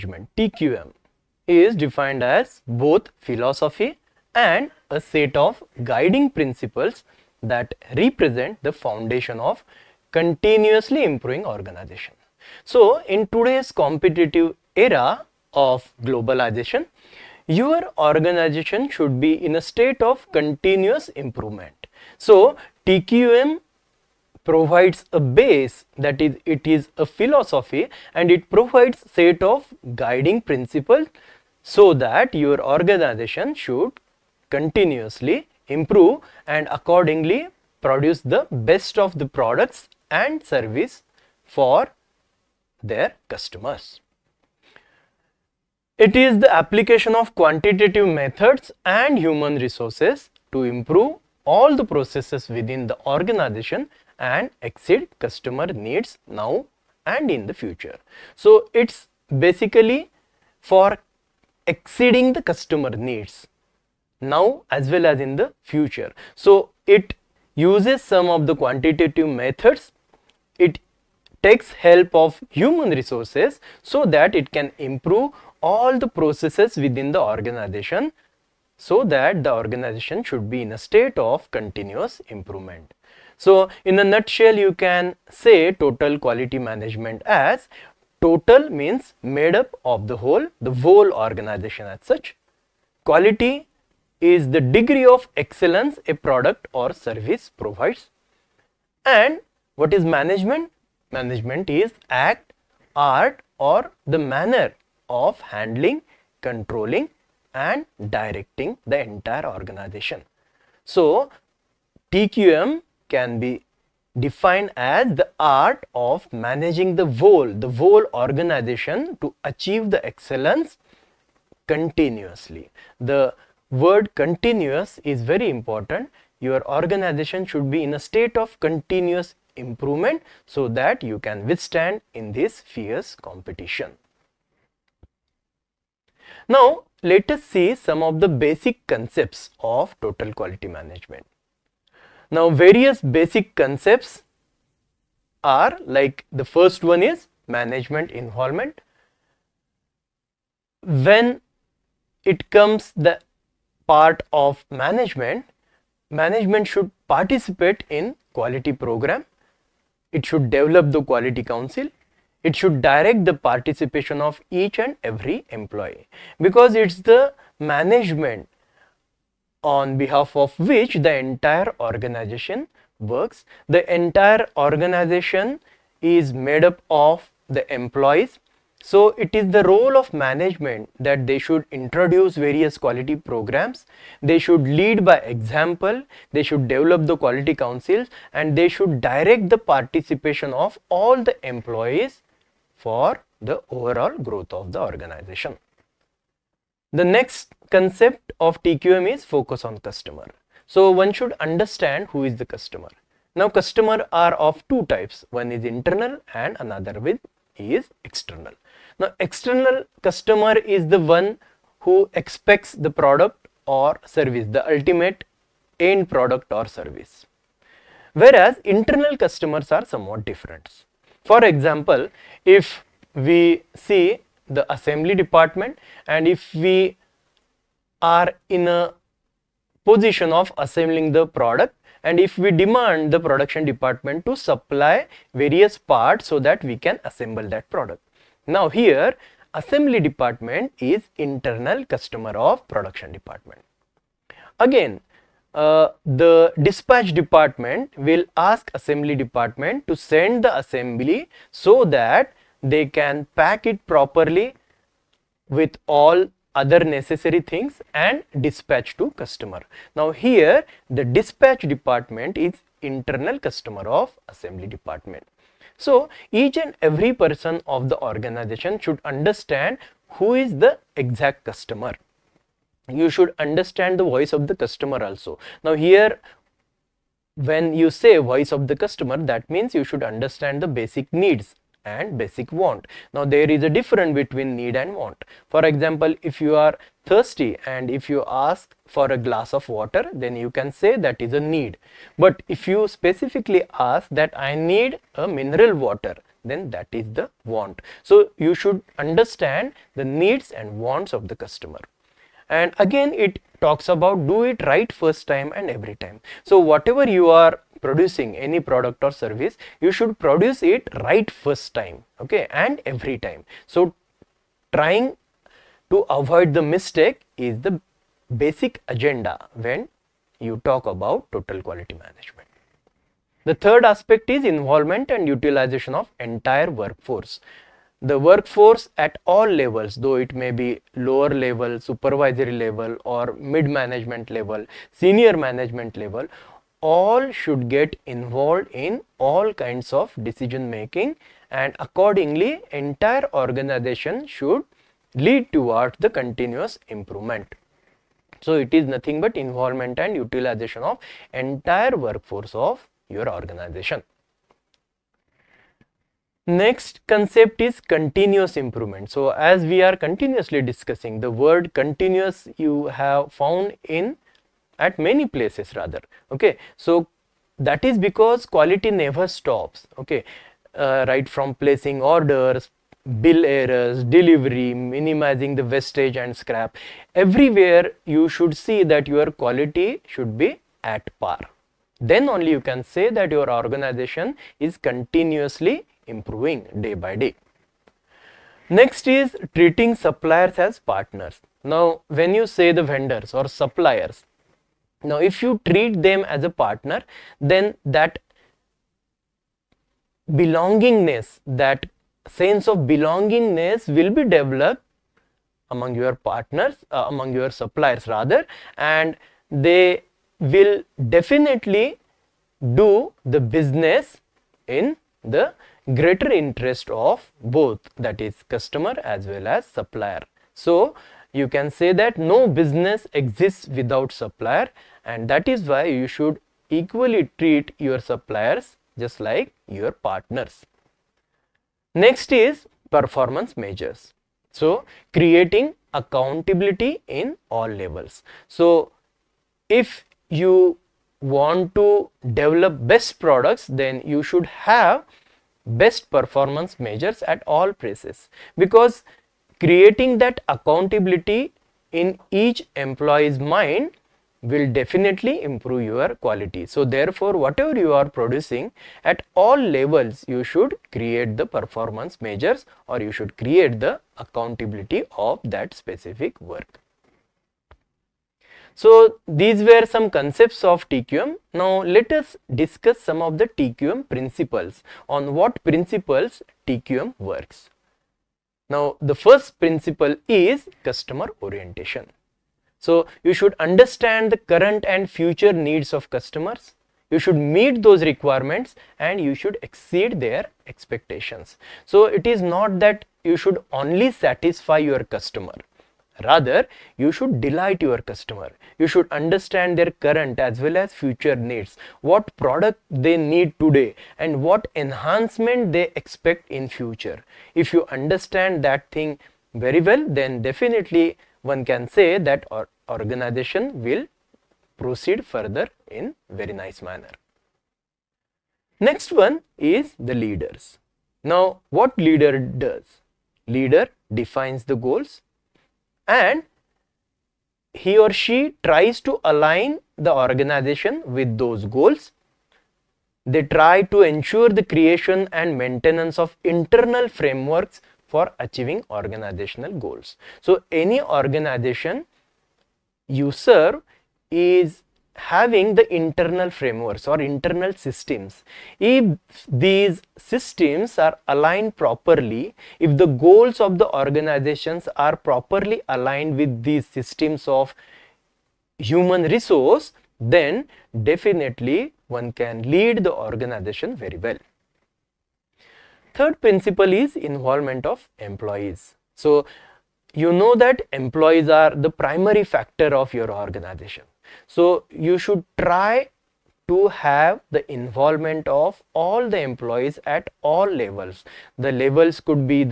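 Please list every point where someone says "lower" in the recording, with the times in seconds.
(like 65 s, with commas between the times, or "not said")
330 s.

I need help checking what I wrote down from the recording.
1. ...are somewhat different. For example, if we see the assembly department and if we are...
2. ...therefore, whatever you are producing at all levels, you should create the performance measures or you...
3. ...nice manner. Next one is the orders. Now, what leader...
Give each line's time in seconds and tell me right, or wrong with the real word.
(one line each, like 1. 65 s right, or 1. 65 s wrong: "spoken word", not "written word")
1. 219 s right
2. 456 s right
3. 516 s wrong: "leaders", not "orders".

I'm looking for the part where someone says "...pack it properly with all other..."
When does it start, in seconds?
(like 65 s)
253 s.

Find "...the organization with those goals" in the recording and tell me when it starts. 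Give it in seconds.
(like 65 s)
529 s.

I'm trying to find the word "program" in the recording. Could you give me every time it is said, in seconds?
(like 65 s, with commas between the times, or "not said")
158 s, 183 s.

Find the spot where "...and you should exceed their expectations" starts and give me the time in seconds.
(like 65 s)
488 s.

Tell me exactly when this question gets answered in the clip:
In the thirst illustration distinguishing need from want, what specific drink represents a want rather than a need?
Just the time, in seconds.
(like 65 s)
295 s.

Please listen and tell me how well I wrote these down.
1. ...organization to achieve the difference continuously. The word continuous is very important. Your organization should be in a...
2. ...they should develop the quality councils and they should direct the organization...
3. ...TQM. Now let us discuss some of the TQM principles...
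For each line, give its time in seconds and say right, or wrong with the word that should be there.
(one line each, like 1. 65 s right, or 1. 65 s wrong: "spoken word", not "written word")
1. 118 s wrong: "excellence", not "difference"
2. 186 s wrong: "participation", not "organization"
3. 470 s right.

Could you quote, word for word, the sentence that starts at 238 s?
Now here assembly department is internal customer of production department.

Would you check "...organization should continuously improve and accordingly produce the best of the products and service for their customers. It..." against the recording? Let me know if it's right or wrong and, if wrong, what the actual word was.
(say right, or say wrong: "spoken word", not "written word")
right.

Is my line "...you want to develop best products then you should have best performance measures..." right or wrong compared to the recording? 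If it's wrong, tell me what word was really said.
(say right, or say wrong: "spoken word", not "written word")
right.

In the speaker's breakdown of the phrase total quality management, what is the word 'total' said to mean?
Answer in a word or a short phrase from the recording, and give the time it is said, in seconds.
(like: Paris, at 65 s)
made up of the whole, at 89 s.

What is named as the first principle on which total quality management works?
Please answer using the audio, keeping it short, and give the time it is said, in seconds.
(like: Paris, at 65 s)
customer orientation, at 480 s.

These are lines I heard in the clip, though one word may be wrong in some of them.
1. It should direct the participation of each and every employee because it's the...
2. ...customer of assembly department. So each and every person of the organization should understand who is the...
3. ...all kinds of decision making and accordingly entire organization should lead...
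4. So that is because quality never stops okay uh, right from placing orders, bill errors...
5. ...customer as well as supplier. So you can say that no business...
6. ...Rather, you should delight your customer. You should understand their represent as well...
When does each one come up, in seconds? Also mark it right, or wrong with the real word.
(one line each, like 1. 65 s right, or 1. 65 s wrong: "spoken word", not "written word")
1. 162 s right
2. 263 s right
3. 339 s right
4. 366 s right
5. 418 s right
6. 496 s wrong: "current", not "represent".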